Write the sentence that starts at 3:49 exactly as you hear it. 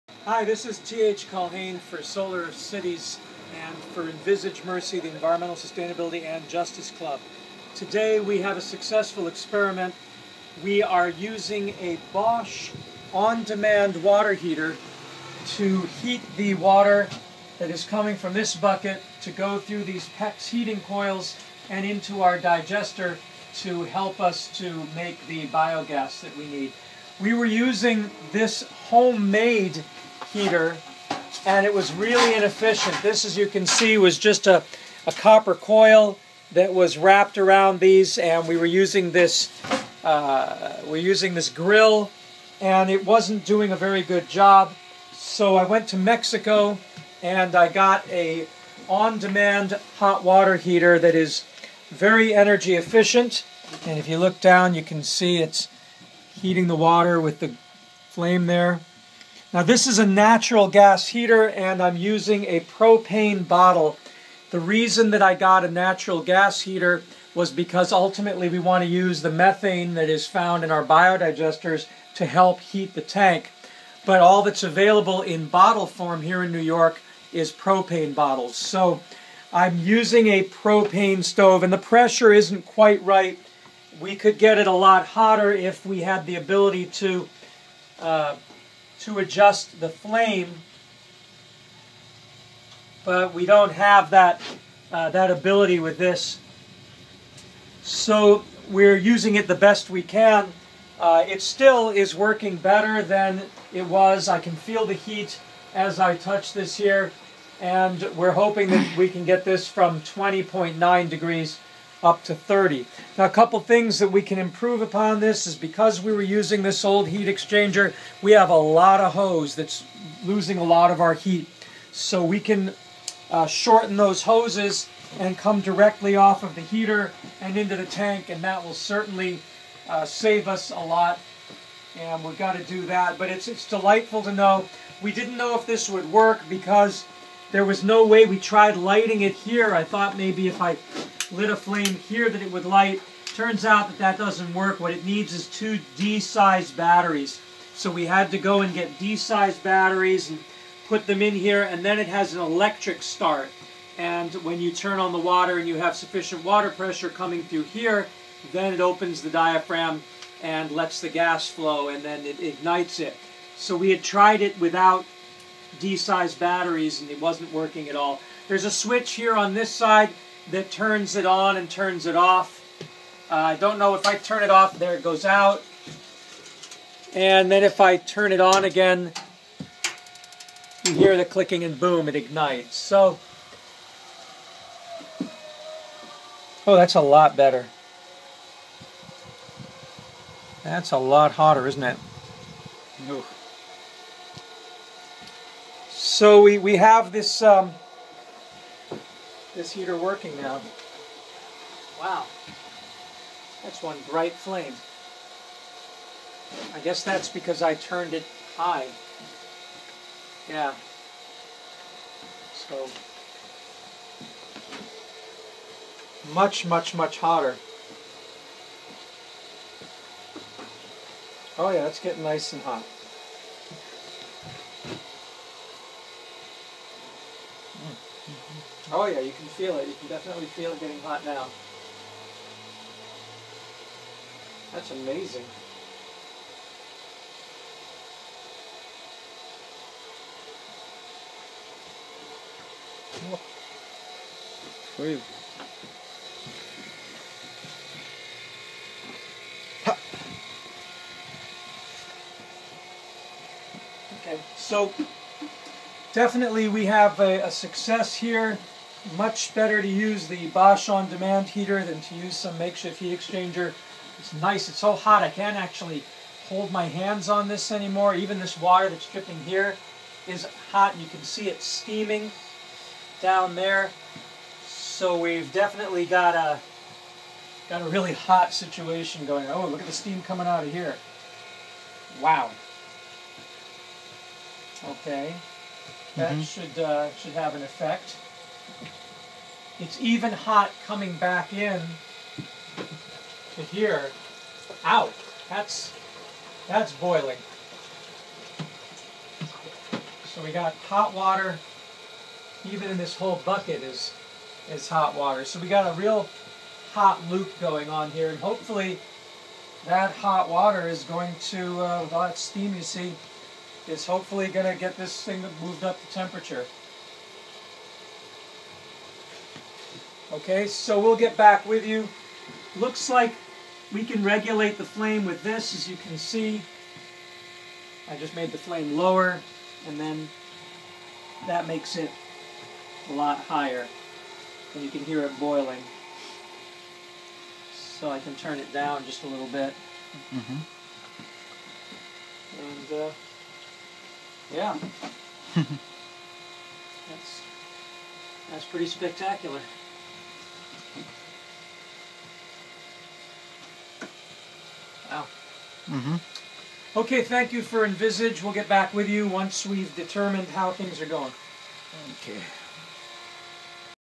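You can definitely feel it getting hot now.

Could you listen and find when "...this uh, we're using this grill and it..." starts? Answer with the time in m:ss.
0:39.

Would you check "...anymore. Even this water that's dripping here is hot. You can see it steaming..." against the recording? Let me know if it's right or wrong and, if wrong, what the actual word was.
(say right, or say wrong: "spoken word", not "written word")
right.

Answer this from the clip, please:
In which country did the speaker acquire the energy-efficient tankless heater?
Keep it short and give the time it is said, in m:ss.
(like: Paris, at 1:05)
Mexico, at 0:45.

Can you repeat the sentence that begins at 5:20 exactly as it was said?
Okay, so we'll get back with you.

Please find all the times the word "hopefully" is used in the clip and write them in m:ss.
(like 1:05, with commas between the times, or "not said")
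5:08, 5:14.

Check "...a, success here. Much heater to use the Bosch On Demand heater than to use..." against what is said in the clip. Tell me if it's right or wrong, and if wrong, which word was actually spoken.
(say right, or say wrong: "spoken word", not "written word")
wrong: "better", not "heater".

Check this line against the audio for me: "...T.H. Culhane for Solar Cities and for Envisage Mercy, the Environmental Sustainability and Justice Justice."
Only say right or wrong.
wrong.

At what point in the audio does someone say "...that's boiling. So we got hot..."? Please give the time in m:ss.
4:56.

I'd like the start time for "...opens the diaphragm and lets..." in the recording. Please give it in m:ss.
2:38.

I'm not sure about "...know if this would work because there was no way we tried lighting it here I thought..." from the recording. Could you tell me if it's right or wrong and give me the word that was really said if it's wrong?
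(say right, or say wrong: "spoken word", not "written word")
right.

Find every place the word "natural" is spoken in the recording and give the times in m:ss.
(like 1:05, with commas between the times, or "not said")
1:00, 1:05.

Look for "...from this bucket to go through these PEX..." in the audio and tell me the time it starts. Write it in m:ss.
0:18.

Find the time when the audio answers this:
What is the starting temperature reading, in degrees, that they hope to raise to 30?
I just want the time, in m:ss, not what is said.
1:50.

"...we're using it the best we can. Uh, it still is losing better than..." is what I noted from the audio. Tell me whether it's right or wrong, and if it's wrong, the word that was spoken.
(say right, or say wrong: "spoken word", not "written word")
wrong: "working", not "losing".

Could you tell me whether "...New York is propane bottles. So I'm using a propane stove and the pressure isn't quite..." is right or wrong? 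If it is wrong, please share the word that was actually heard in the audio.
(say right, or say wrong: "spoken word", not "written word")
right.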